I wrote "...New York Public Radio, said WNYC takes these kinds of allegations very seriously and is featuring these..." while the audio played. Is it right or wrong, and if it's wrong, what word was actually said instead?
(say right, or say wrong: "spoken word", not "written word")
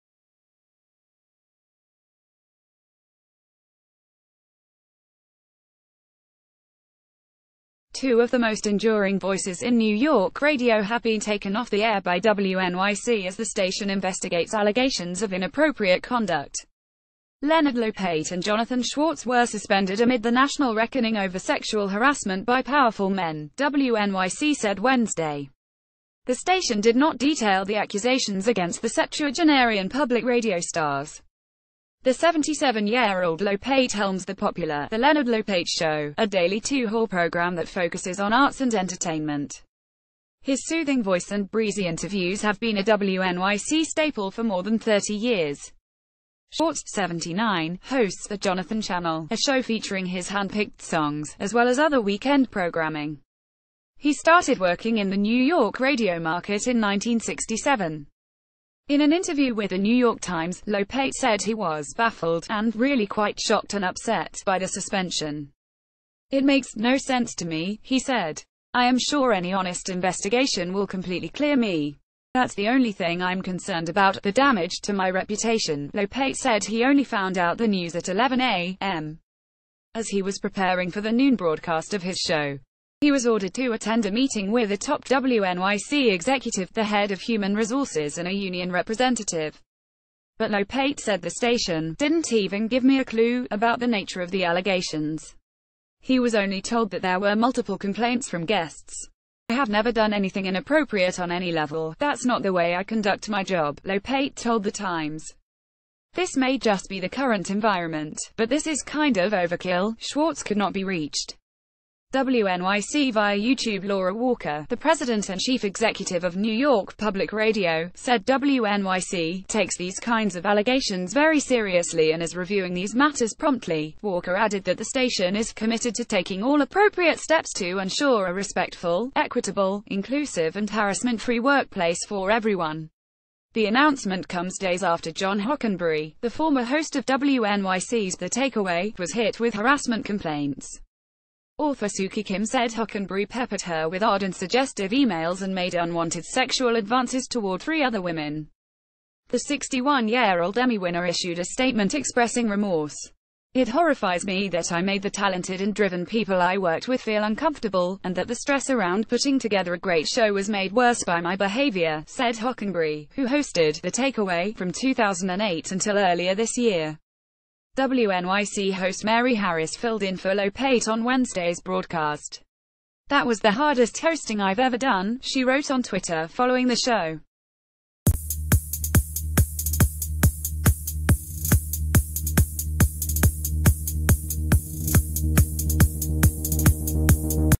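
wrong: "reviewing", not "featuring".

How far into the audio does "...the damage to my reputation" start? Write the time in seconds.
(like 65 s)
74 s.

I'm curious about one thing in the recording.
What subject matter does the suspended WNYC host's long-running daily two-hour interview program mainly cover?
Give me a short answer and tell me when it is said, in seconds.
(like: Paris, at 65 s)
arts and entertainment, at 38 s.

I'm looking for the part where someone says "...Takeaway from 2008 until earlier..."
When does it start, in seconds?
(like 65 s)
163 s.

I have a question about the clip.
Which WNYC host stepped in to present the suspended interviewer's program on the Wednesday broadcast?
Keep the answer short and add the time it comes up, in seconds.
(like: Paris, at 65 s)
Mary Harris, at 169 s.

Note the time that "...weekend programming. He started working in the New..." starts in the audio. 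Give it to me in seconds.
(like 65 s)
52 s.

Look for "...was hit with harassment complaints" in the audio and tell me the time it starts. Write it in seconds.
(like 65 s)
138 s.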